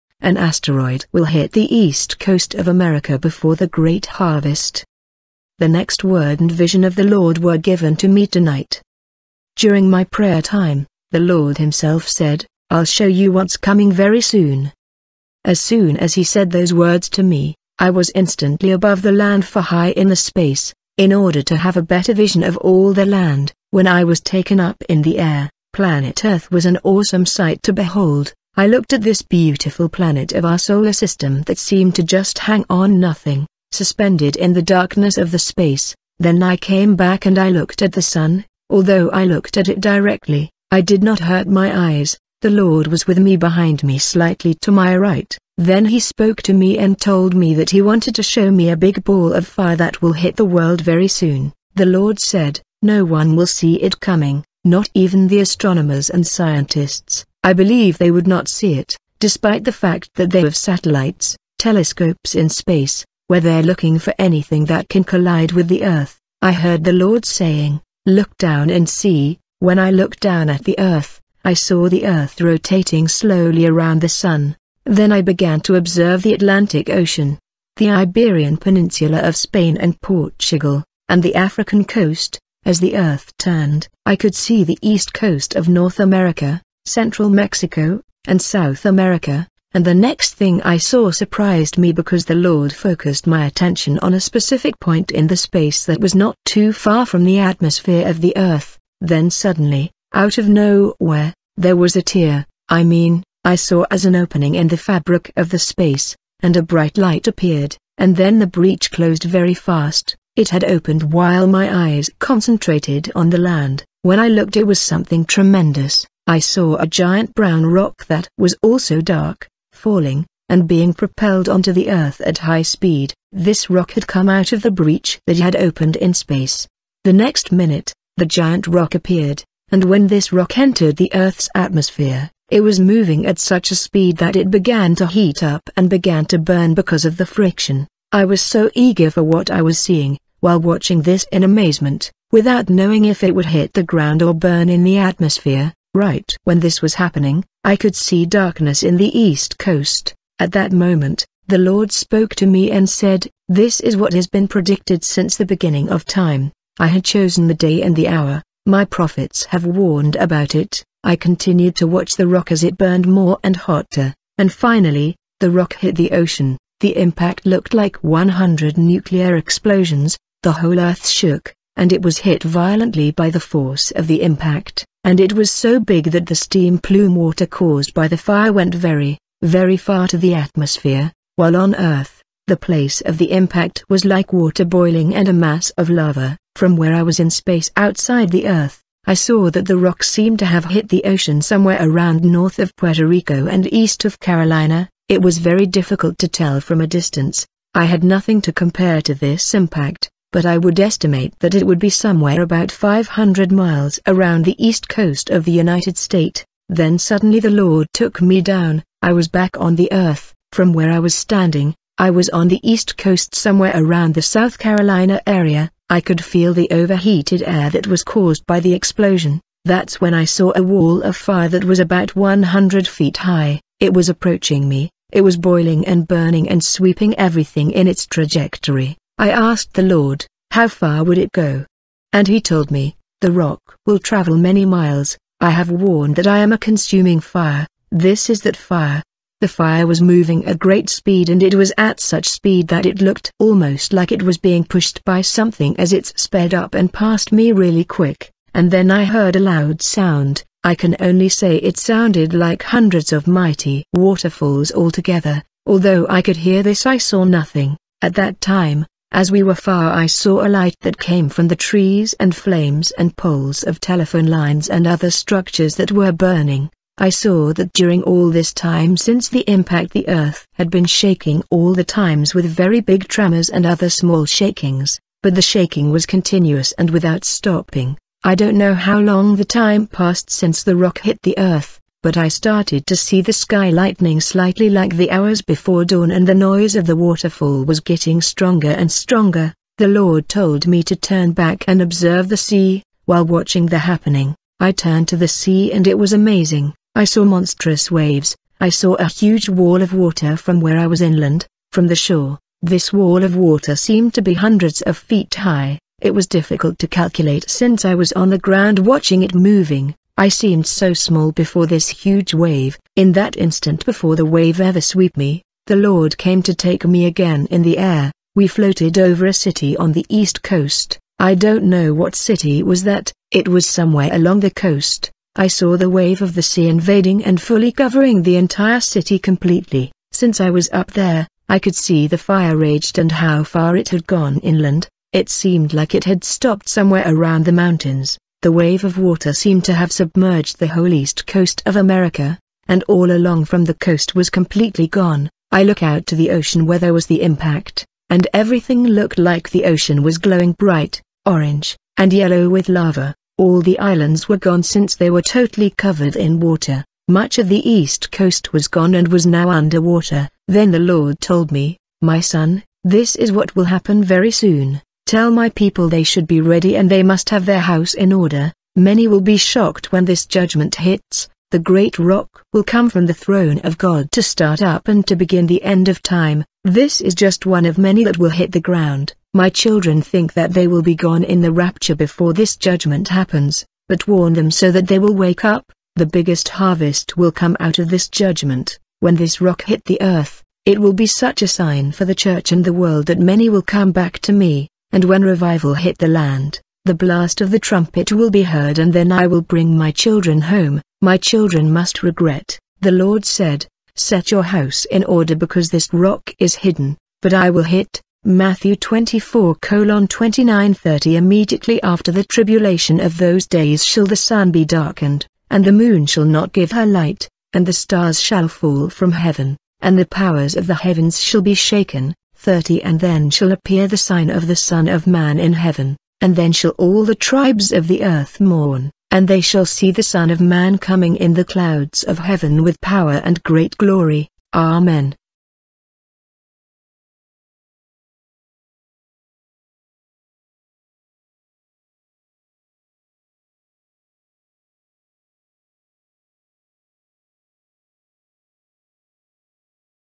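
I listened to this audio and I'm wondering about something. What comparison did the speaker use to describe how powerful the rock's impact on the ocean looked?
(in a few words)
100 nuclear explosions.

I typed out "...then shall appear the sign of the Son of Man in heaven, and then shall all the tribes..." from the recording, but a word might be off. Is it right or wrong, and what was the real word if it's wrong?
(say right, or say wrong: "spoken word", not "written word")
right.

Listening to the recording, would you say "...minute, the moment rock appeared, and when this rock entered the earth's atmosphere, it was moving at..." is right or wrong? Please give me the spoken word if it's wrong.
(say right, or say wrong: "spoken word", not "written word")
wrong: "giant", not "moment".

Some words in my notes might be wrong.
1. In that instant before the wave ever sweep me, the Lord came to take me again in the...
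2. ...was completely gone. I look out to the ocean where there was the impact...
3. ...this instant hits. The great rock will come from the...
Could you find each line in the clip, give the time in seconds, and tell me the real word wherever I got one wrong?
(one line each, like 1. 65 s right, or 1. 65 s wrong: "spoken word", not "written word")
1. 312 s right
2. 344 s right
3. 370 s wrong: "judgment", not "instant".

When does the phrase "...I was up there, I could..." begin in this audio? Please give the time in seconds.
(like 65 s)
330 s.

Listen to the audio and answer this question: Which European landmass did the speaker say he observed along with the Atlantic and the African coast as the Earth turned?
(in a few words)
Iberian Peninsula.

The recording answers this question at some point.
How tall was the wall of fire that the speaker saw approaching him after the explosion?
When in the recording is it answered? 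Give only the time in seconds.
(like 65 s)
222 s.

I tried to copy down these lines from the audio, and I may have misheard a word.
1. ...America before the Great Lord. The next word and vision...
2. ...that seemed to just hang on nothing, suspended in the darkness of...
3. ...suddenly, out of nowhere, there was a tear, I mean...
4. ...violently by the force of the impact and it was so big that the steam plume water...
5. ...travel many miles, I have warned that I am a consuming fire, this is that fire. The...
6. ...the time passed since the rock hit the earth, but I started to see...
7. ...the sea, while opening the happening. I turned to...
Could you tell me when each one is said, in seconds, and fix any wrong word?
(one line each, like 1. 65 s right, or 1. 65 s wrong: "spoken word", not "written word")
1. 2 s wrong: "Harvest", not "Lord"
2. 31 s right
3. 99 s right
4. 172 s right
5. 233 s right
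6. 279 s right
7. 292 s wrong: "watching", not "opening".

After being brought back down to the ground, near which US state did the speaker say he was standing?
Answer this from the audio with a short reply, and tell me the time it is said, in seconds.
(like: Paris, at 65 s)
South Carolina, at 214 s.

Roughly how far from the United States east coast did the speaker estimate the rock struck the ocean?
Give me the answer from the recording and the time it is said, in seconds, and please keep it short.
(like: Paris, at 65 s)
500 miles, at 202 s.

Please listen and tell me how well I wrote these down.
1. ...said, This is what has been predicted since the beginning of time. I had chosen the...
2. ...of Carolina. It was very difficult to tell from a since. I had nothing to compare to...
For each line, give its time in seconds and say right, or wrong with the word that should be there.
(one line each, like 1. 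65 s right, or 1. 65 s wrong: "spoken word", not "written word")
1. 152 s right
2. 194 s wrong: "distance", not "since".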